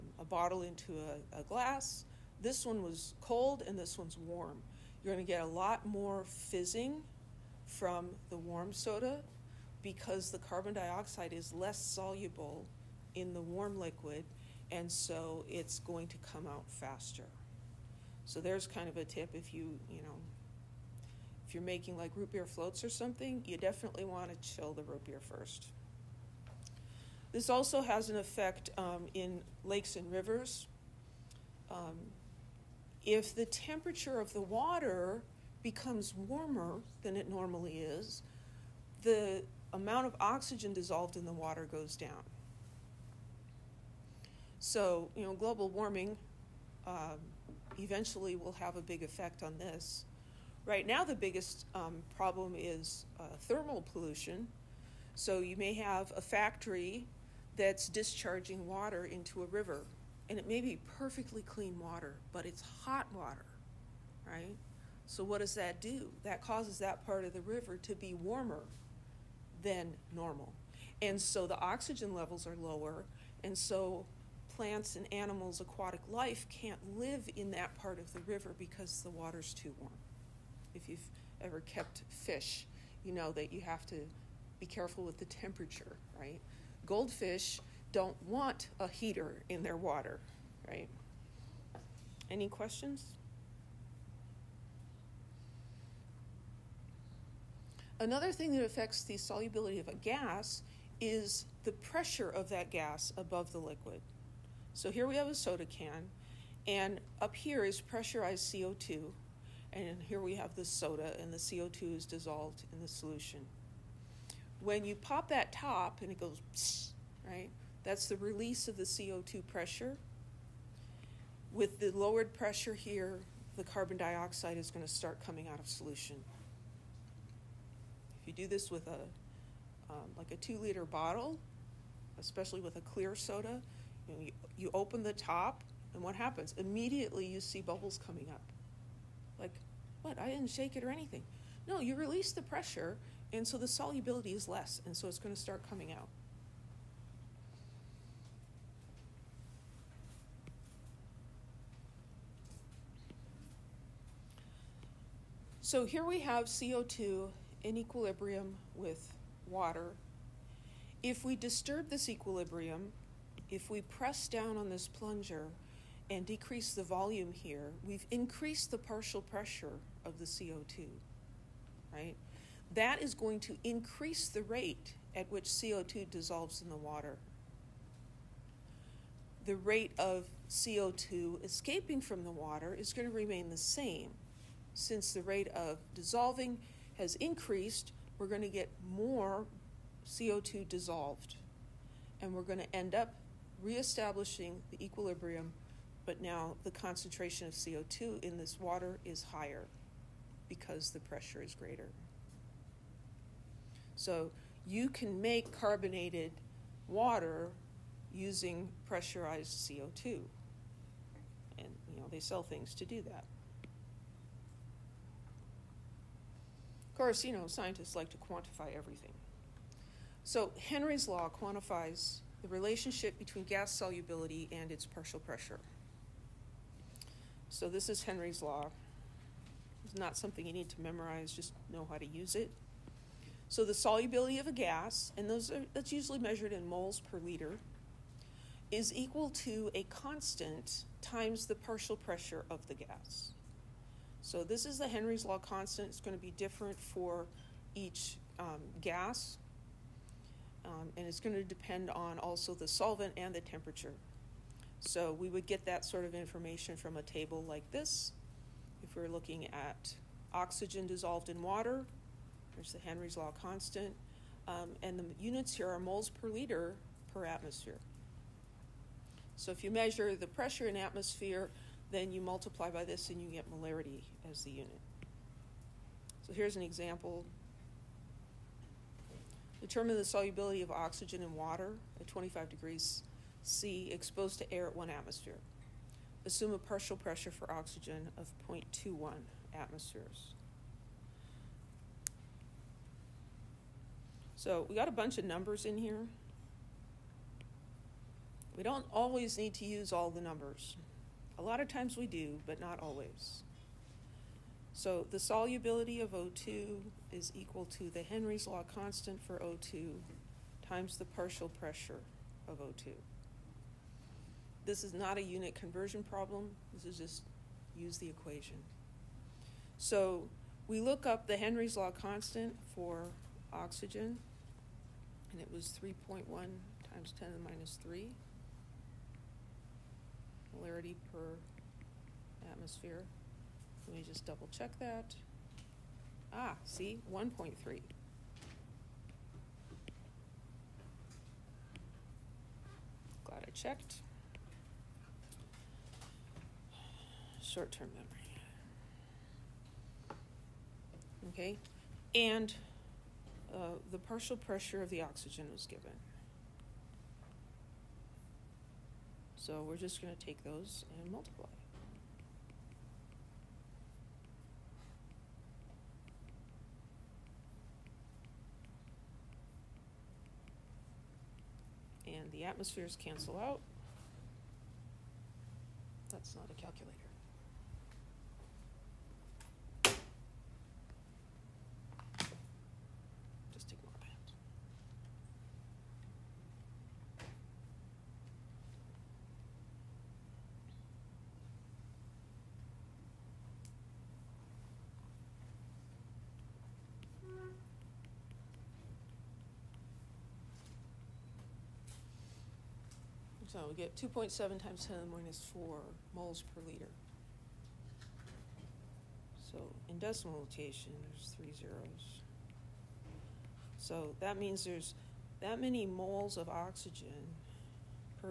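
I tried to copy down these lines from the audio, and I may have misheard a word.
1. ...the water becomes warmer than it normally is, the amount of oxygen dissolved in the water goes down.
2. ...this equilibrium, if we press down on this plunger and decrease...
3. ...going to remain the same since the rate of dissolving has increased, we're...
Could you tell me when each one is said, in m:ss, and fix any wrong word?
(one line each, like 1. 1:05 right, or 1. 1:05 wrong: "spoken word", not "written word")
1. 0:34 right
2. 2:41 right
3. 3:02 right.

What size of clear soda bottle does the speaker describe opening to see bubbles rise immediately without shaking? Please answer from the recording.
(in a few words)
two liter.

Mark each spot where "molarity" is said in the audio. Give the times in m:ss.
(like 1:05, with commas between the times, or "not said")
4:33, 5:30.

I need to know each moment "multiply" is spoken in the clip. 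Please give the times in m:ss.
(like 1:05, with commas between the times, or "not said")
4:32, 6:01.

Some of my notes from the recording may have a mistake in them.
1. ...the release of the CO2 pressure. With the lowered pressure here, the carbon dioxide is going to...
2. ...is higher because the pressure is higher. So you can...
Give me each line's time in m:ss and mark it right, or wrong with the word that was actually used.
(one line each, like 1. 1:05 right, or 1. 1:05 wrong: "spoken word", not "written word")
1. 1:58 right
2. 3:19 wrong: "greater", not "higher".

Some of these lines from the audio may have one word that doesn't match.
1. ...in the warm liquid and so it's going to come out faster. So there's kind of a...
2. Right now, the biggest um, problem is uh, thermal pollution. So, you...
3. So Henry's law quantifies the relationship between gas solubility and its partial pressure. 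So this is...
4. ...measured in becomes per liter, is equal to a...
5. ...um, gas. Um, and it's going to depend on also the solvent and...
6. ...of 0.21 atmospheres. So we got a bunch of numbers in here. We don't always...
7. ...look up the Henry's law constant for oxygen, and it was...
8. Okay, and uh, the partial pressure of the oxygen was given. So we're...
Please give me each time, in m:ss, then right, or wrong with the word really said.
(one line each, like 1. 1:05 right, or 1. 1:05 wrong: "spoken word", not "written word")
1. 0:13 right
2. 0:50 right
3. 3:40 right
4. 3:56 wrong: "moles", not "becomes"
5. 4:08 right
6. 4:48 right
7. 5:20 right
8. 5:51 right.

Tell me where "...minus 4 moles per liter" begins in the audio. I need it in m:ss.
6:45.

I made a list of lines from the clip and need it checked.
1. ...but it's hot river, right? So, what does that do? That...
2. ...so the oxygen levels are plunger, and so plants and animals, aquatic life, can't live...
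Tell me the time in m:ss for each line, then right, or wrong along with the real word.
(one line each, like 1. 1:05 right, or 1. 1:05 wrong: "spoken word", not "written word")
1. 1:02 wrong: "water", not "river"
2. 1:11 wrong: "lower", not "plunger".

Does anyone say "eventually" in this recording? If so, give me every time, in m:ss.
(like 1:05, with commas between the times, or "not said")
0:47.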